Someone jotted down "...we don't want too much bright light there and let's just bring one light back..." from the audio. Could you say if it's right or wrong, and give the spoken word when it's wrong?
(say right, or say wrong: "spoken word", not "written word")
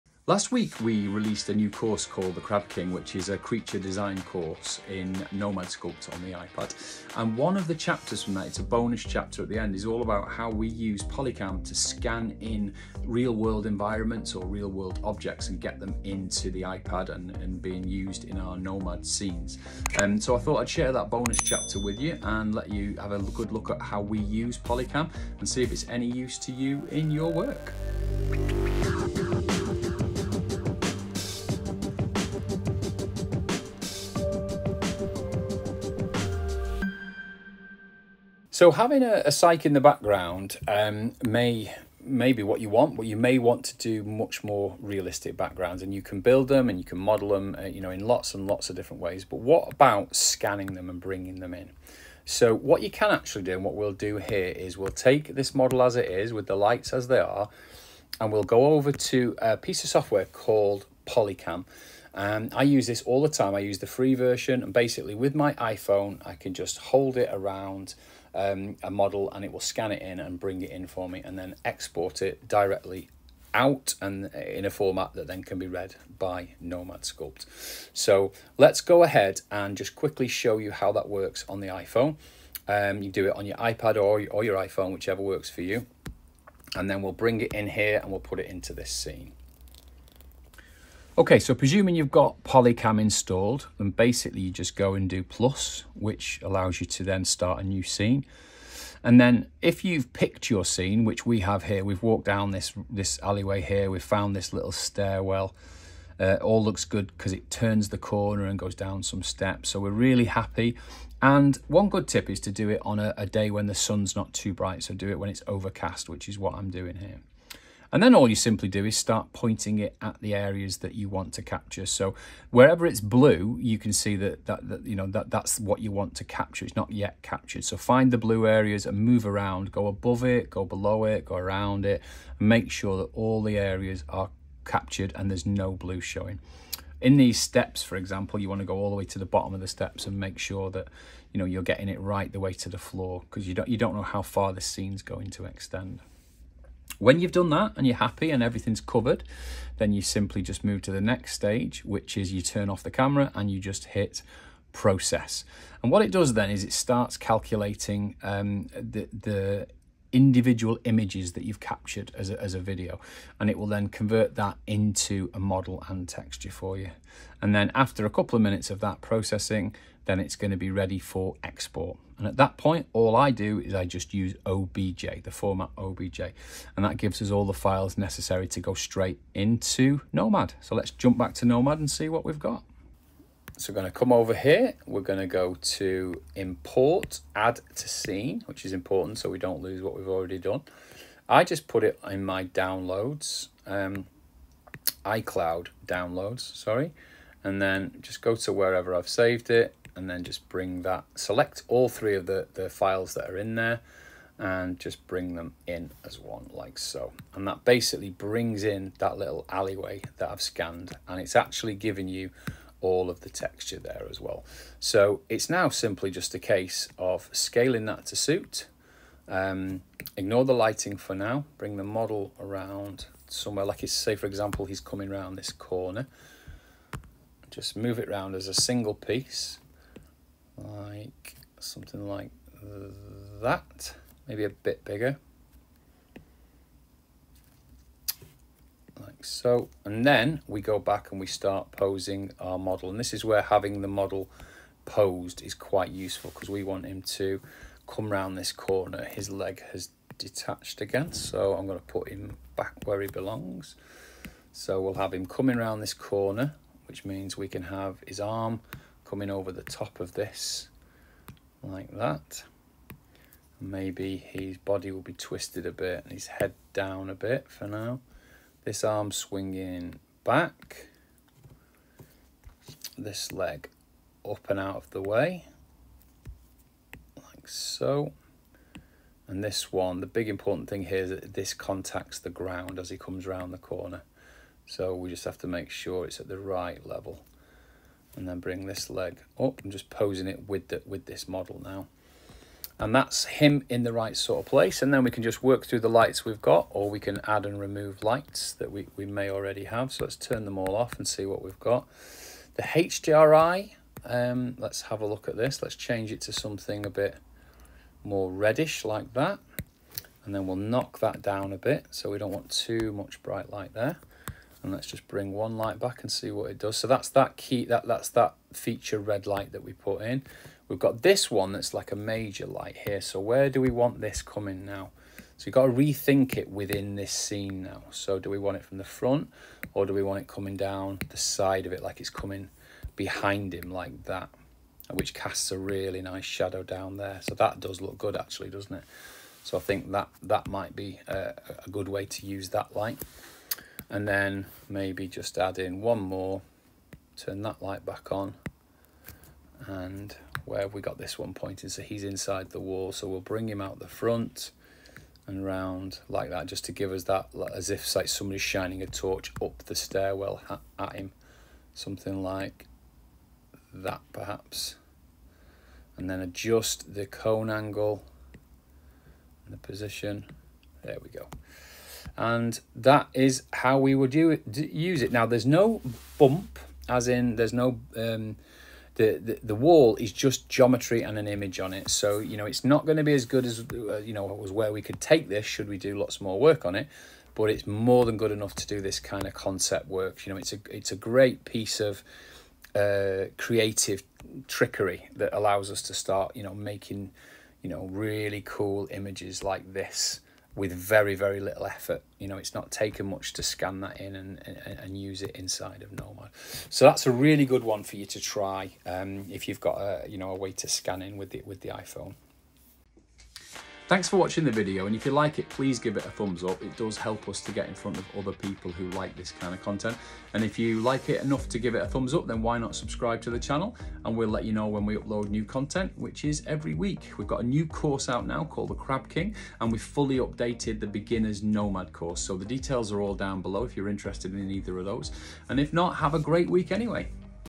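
right.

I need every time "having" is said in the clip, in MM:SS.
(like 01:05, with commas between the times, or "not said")
00:38, 04:03.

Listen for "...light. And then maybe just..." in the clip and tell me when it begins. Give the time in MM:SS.
05:42.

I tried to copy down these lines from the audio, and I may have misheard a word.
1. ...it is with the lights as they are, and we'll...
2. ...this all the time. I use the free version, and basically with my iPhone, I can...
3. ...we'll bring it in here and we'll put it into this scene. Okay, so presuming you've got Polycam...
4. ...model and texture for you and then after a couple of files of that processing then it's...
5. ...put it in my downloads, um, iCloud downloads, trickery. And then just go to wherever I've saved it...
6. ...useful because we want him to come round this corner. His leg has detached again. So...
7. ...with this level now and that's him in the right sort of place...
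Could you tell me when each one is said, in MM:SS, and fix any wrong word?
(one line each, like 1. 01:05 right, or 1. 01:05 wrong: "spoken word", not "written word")
1. 00:55 right
2. 01:02 right
3. 01:27 right
4. 02:45 wrong: "minutes", not "files"
5. 03:11 wrong: "sorry", not "trickery"
6. 04:05 right
7. 04:50 wrong: "model", not "level".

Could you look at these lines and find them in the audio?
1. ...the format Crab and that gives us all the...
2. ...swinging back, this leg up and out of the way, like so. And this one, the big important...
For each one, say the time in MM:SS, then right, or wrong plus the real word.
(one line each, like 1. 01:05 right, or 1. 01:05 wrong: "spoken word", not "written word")
1. 02:55 wrong: "OBJ", not "Crab"
2. 04:29 right.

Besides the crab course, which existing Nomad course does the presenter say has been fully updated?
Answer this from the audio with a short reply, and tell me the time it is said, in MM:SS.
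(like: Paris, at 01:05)
The beginner's Nomad course, at 07:10.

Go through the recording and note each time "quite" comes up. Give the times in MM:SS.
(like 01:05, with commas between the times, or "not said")
04:05.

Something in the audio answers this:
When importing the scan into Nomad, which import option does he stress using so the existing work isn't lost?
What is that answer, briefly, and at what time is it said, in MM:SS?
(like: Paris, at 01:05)
Add to scene, at 03:07.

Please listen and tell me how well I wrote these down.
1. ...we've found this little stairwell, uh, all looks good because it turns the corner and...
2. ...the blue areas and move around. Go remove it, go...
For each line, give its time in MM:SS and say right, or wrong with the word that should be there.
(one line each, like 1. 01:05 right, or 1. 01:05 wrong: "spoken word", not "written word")
1. 01:43 right
2. 02:08 wrong: "above", not "remove".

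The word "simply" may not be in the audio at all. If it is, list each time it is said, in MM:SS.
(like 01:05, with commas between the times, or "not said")
01:58, 02:30, 03:35.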